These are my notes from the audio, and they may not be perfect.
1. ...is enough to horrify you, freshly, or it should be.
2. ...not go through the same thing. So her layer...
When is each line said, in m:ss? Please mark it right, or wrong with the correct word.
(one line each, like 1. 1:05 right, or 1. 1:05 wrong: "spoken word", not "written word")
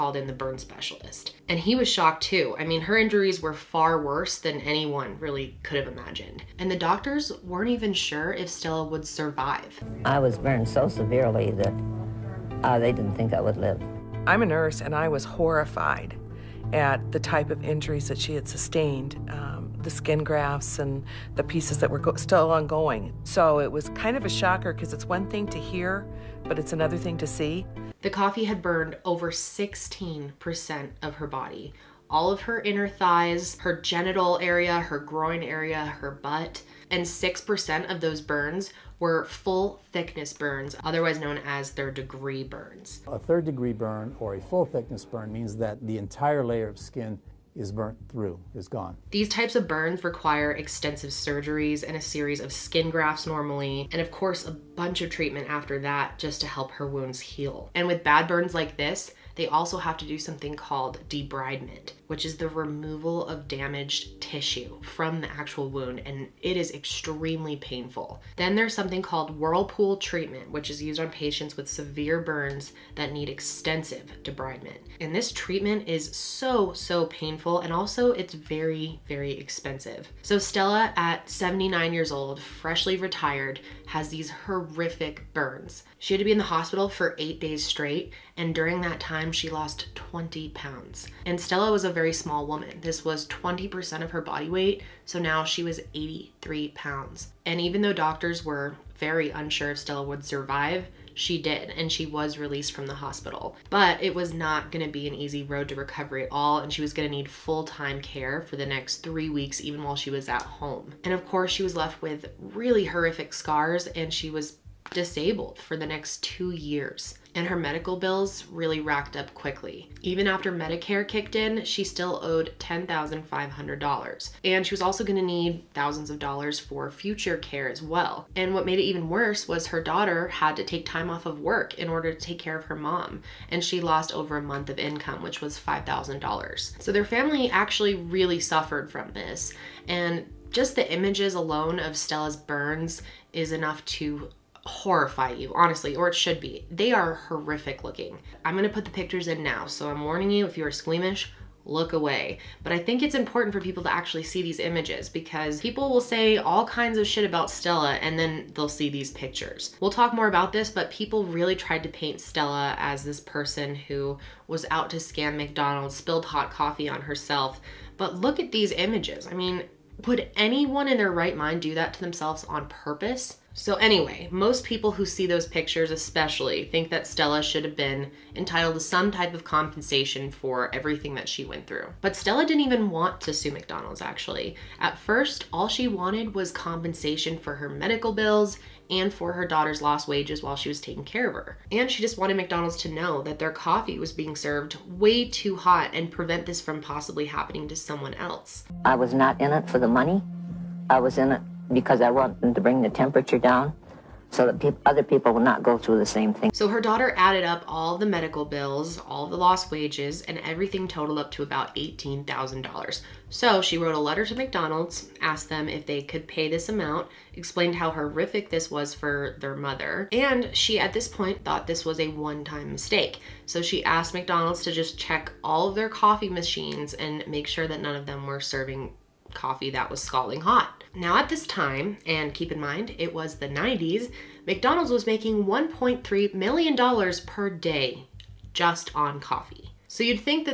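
1. 2:23 wrong: "honestly", not "freshly"
2. 3:25 wrong: "daughter", not "layer".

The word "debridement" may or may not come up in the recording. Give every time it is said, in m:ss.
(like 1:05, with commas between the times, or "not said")
1:01, 1:14.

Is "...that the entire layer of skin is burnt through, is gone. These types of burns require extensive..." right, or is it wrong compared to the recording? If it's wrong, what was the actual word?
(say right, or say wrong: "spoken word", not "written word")
right.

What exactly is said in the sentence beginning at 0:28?
The coffee had burned over 16% of her body.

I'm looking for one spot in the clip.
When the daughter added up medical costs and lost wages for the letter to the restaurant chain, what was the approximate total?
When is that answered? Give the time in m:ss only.
3:31.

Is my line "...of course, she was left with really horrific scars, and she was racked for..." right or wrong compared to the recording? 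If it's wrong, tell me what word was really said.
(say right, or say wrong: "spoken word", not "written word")
wrong: "disabled", not "racked".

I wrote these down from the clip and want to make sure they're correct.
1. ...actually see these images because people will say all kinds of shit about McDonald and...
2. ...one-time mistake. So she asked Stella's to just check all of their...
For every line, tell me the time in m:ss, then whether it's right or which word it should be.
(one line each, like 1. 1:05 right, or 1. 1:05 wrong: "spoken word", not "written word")
1. 2:33 wrong: "Stella", not "McDonald"
2. 3:42 wrong: "McDonald", not "Stella".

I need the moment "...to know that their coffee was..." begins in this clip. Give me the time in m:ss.
3:12.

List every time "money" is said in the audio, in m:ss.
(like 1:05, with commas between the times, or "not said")
3:19.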